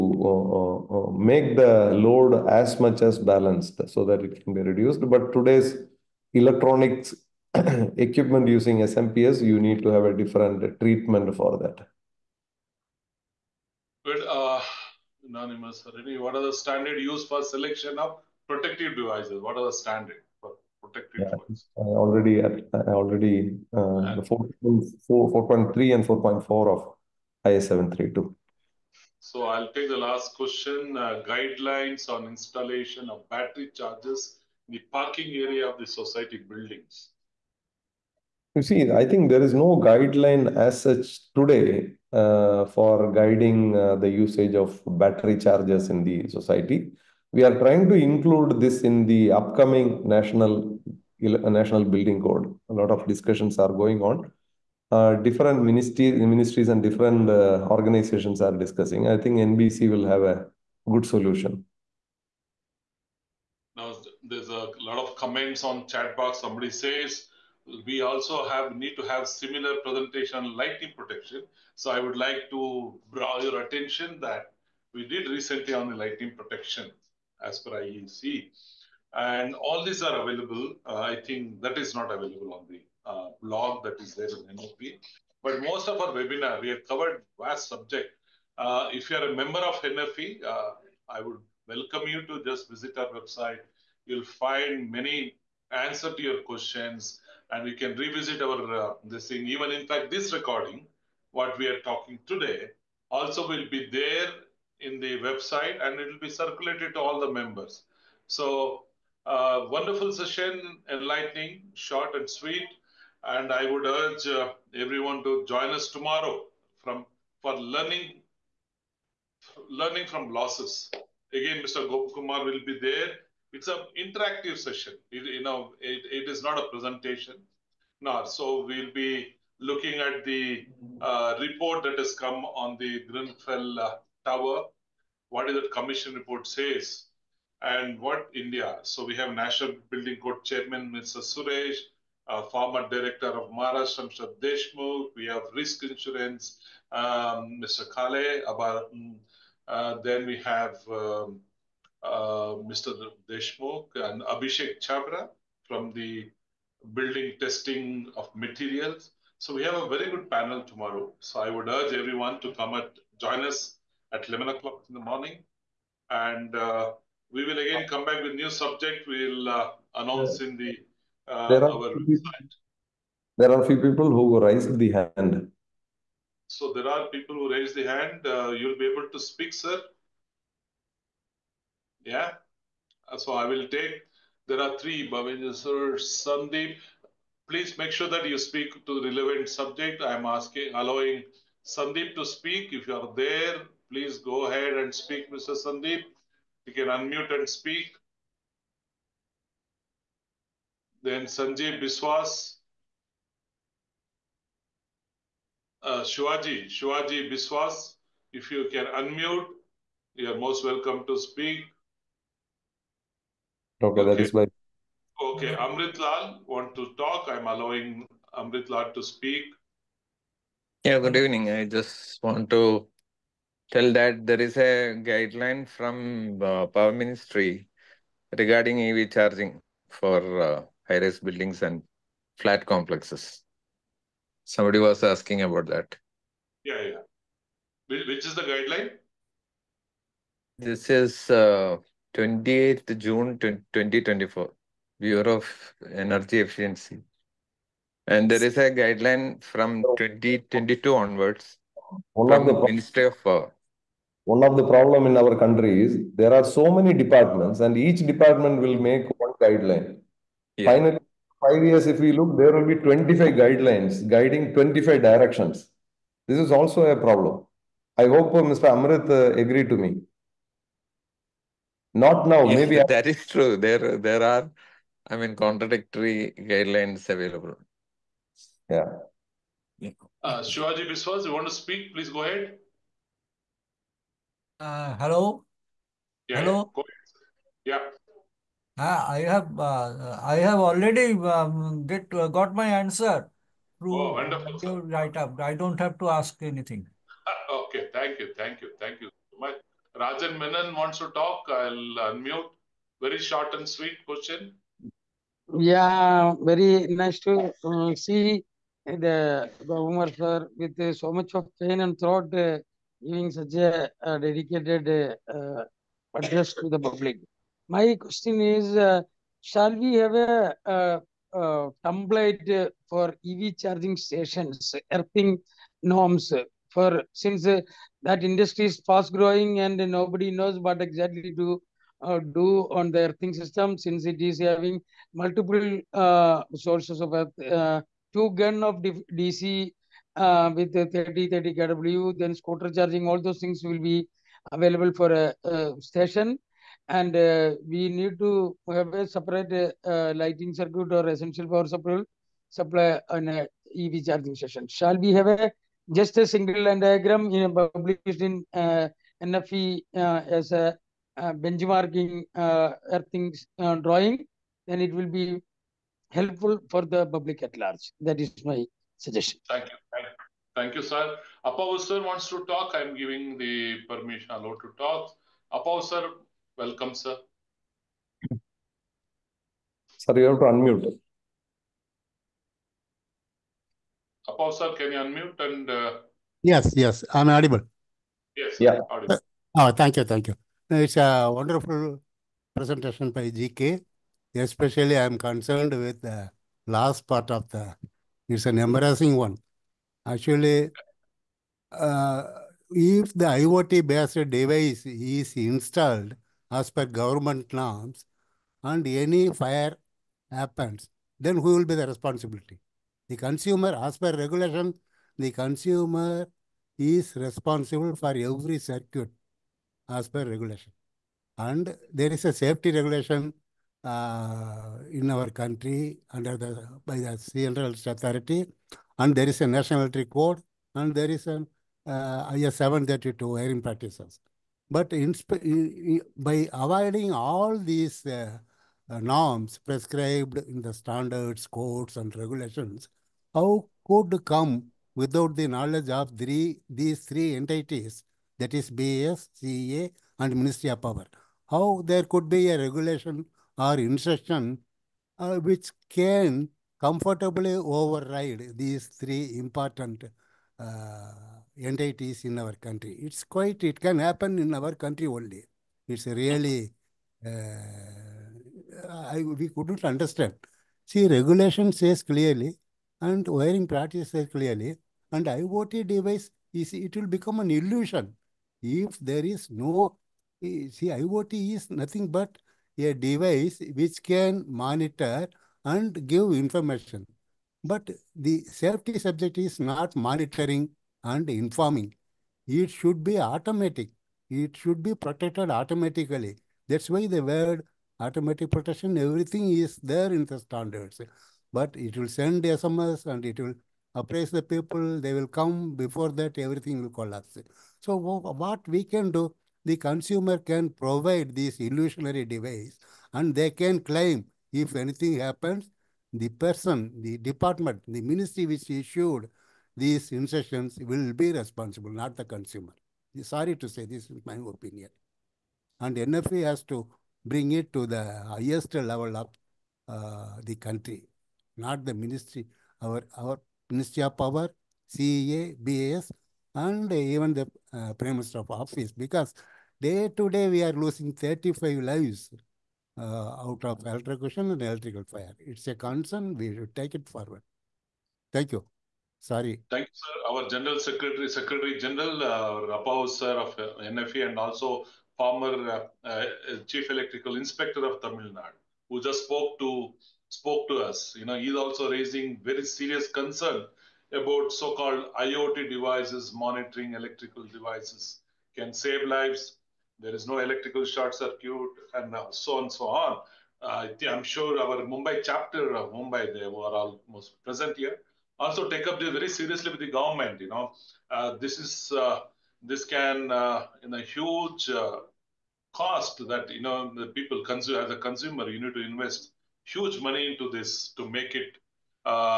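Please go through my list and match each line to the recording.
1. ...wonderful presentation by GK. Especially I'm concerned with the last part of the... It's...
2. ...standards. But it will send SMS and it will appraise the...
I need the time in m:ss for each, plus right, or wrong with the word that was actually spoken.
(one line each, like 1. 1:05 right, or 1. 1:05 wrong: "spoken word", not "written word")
1. 6:31 right
2. 8:20 right.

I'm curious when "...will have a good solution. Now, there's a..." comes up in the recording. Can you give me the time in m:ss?
0:59.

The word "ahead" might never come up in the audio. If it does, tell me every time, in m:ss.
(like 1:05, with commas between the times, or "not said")
3:14, 4:42.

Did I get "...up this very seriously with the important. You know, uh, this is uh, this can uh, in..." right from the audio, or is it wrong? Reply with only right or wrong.
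wrong.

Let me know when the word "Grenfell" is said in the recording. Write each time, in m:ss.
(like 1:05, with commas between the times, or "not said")
2:13.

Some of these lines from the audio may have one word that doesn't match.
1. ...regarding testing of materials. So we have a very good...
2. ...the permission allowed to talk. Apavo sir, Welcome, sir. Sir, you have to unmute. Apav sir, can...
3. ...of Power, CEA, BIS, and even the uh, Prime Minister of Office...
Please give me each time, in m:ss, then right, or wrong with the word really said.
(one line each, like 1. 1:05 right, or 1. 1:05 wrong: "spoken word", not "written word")
1. 2:36 wrong: "building", not "regarding"
2. 6:13 right
3. 8:54 right.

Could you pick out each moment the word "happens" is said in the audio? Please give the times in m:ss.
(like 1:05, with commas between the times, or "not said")
6:50, 7:43, 8:35.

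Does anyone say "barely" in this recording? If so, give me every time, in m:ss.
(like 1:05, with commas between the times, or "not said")
not said.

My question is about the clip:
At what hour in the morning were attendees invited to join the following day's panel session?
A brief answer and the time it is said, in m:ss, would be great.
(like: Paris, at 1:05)
11 o'clock, at 2:44.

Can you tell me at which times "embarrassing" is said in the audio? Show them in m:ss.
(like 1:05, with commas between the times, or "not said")
6:38.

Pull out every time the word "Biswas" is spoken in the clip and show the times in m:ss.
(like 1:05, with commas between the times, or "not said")
3:21, 3:27, 4:40.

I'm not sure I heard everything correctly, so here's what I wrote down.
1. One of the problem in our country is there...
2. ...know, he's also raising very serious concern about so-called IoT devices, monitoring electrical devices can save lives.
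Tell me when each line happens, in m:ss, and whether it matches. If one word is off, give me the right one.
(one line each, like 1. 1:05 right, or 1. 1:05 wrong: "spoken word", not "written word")
1. 4:14 right
2. 9:21 right.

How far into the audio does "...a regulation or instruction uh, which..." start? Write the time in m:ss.
7:32.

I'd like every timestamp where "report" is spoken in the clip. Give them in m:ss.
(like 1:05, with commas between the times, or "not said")
2:11, 2:16.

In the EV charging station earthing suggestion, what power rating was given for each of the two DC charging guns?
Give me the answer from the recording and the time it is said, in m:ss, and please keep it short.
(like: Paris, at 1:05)
30 kW, at 5:40.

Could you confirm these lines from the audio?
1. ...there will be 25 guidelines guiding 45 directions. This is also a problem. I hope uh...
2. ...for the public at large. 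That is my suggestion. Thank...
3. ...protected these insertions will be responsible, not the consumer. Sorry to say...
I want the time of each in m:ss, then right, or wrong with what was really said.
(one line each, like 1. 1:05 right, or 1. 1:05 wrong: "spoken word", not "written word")
1. 4:22 wrong: "25", not "45"
2. 6:06 right
3. 8:38 wrong: "issued", not "protected".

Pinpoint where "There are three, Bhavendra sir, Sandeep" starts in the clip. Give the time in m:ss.
3:04.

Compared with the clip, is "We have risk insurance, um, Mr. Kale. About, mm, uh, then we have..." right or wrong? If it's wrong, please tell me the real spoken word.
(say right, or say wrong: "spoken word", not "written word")
right.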